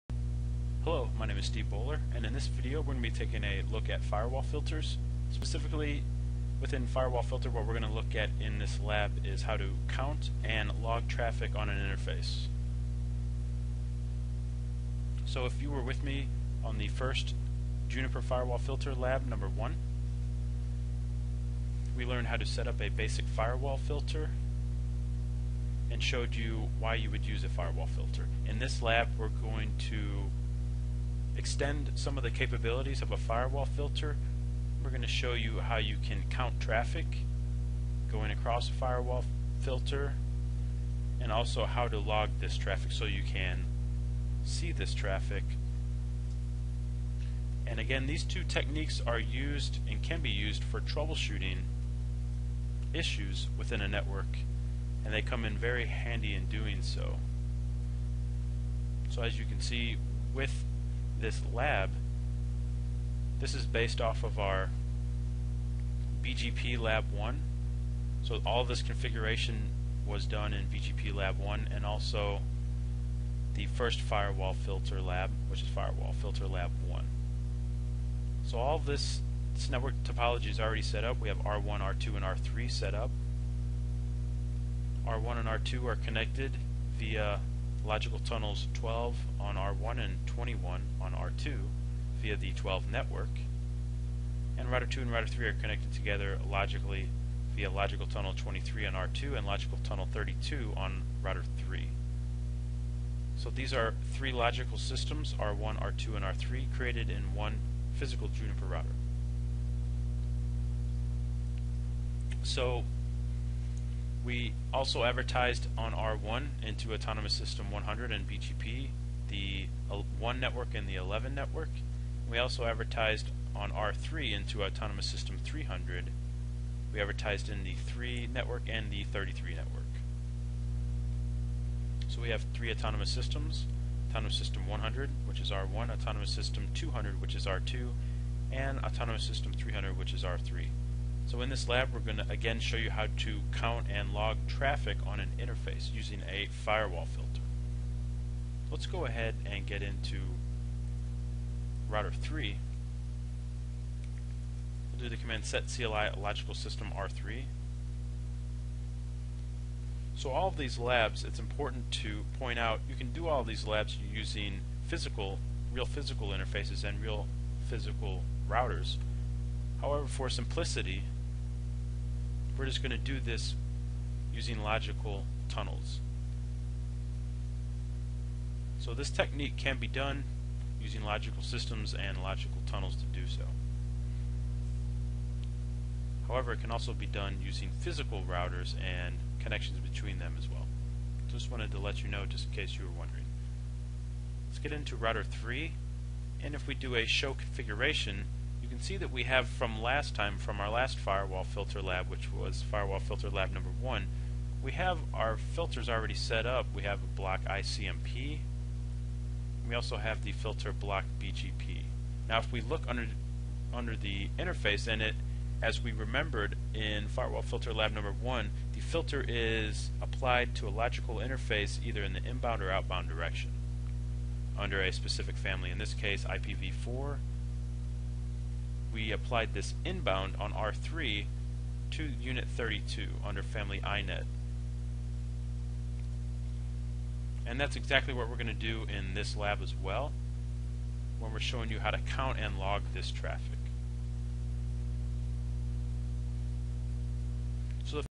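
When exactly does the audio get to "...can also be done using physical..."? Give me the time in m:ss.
3:06.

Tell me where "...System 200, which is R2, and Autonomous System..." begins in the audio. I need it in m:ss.
2:16.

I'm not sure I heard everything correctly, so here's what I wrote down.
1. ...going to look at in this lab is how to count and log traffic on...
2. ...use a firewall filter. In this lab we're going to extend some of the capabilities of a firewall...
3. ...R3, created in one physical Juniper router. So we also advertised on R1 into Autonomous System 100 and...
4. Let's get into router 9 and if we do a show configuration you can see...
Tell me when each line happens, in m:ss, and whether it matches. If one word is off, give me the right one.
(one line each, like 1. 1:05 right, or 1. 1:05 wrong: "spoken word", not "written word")
1. 0:07 right
2. 0:27 right
3. 1:46 right
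4. 3:14 wrong: "3", not "9".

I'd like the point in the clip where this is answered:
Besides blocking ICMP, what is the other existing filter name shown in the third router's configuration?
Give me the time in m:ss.
3:30.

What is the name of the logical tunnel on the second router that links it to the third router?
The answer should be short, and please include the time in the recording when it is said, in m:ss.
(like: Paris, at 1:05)
logical tunnel 23, at 1:37.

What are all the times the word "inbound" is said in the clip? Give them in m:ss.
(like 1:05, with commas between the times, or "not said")
3:42, 3:49.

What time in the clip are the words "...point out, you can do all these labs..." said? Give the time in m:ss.
2:42.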